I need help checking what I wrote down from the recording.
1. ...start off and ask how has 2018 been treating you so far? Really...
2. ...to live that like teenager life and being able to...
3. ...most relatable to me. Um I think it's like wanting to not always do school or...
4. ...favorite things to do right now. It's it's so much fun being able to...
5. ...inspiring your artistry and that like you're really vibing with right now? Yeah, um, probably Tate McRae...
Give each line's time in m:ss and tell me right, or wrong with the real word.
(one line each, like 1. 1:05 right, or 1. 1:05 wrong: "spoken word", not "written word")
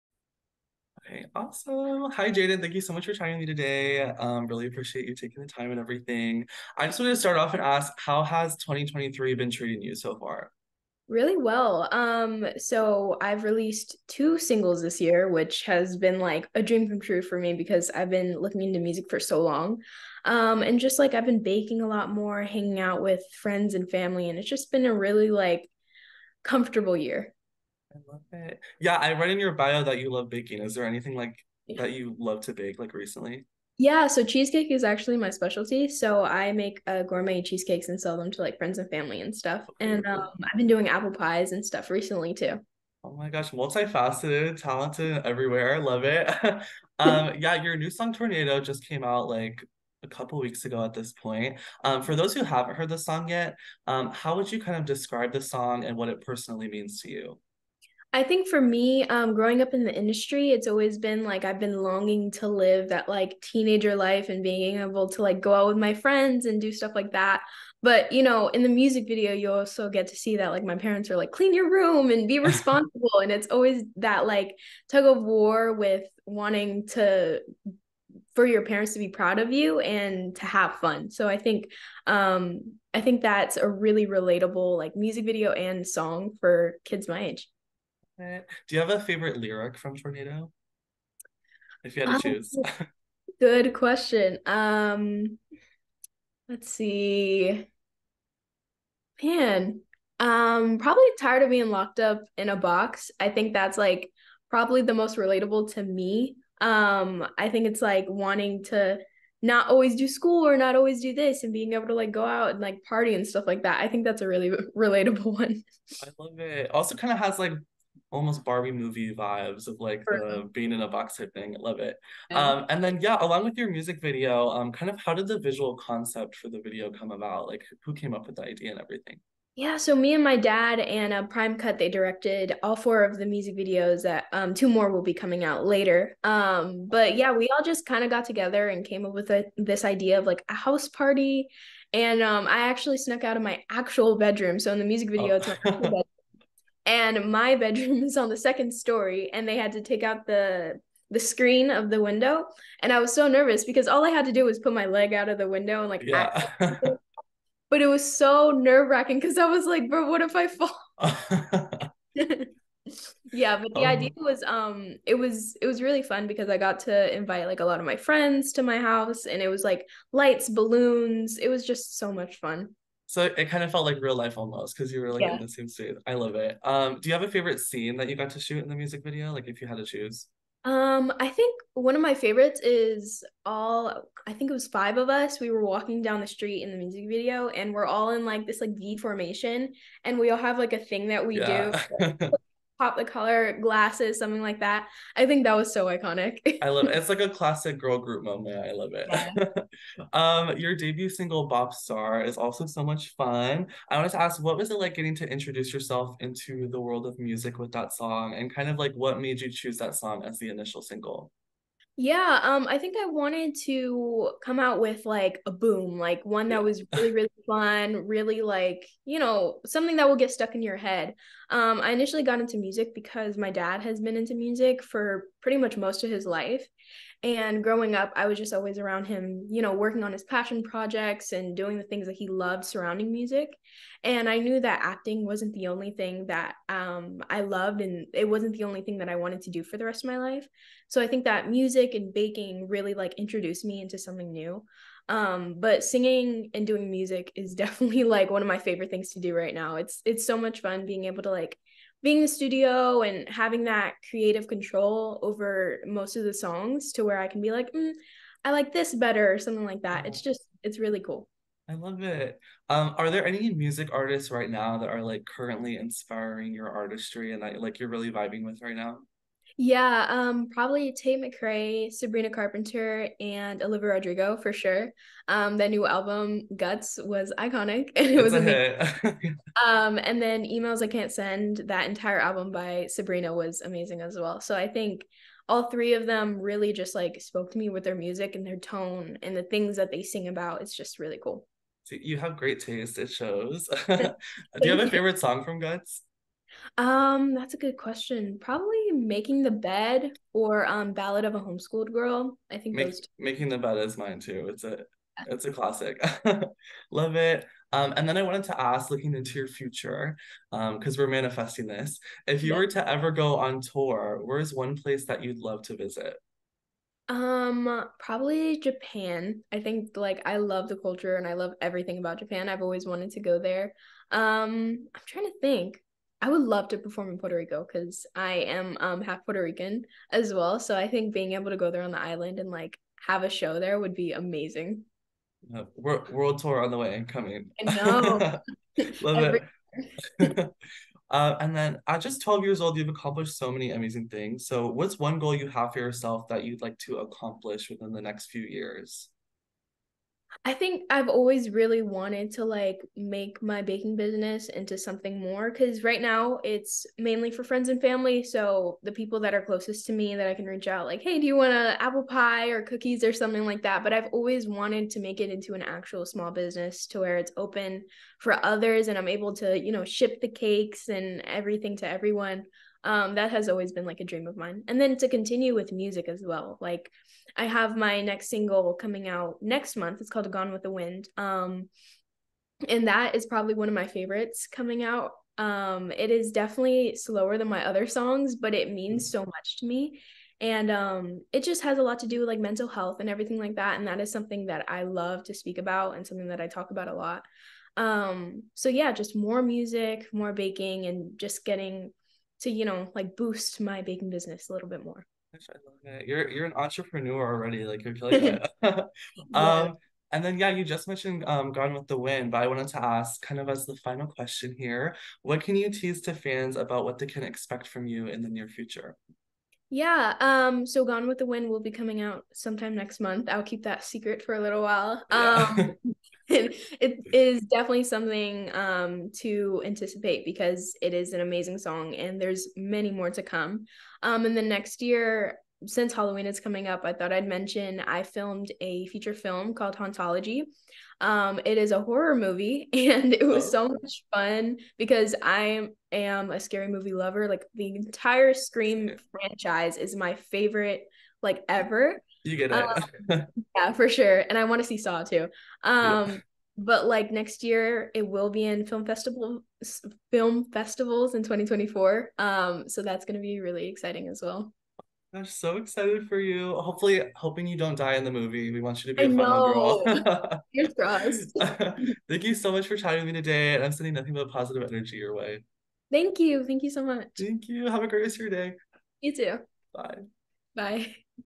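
1. 0:07 wrong: "2023", not "2018"
2. 1:02 right
3. 1:44 right
4. 4:08 right
5. 4:25 right.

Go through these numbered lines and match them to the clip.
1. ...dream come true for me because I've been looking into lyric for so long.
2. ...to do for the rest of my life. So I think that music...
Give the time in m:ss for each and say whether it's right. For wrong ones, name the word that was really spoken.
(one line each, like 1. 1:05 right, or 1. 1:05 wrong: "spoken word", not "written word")
1. 0:16 wrong: "music", not "lyric"
2. 3:59 right.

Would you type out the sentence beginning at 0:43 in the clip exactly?
Oh my gosh, multifaceted, talented everywhere.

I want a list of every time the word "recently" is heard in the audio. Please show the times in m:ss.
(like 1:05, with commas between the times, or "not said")
0:32, 0:41.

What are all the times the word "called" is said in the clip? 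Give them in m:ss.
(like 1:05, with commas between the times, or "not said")
6:20, 7:19.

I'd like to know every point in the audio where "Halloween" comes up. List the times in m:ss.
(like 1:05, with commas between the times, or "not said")
7:15.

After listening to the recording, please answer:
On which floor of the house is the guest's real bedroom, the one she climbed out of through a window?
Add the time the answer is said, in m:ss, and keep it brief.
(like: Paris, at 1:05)
Second story, at 2:28.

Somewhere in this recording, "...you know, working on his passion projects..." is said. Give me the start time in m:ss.
3:49.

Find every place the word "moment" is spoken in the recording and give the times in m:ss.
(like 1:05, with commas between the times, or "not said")
3:18.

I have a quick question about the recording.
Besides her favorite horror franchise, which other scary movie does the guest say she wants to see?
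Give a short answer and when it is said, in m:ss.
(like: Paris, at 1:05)
Saw, at 7:34.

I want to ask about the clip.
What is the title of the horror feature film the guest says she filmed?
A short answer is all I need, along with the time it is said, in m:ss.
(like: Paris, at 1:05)
Hauntology, at 7:19.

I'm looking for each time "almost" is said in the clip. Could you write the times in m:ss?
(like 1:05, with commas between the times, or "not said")
1:58, 2:54.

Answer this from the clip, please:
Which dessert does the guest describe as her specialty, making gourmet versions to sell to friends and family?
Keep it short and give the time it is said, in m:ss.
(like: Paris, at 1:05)
Cheesecake, at 0:34.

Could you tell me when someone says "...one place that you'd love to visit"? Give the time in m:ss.
5:14.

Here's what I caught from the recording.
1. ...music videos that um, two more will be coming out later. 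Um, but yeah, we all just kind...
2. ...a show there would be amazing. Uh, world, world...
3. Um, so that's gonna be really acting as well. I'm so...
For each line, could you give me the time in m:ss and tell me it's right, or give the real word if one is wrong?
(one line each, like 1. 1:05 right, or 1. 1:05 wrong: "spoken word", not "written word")
1. 2:13 right
2. 5:33 right
3. 7:42 wrong: "exciting", not "acting".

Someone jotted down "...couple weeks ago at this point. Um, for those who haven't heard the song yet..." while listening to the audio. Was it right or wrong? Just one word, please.
right.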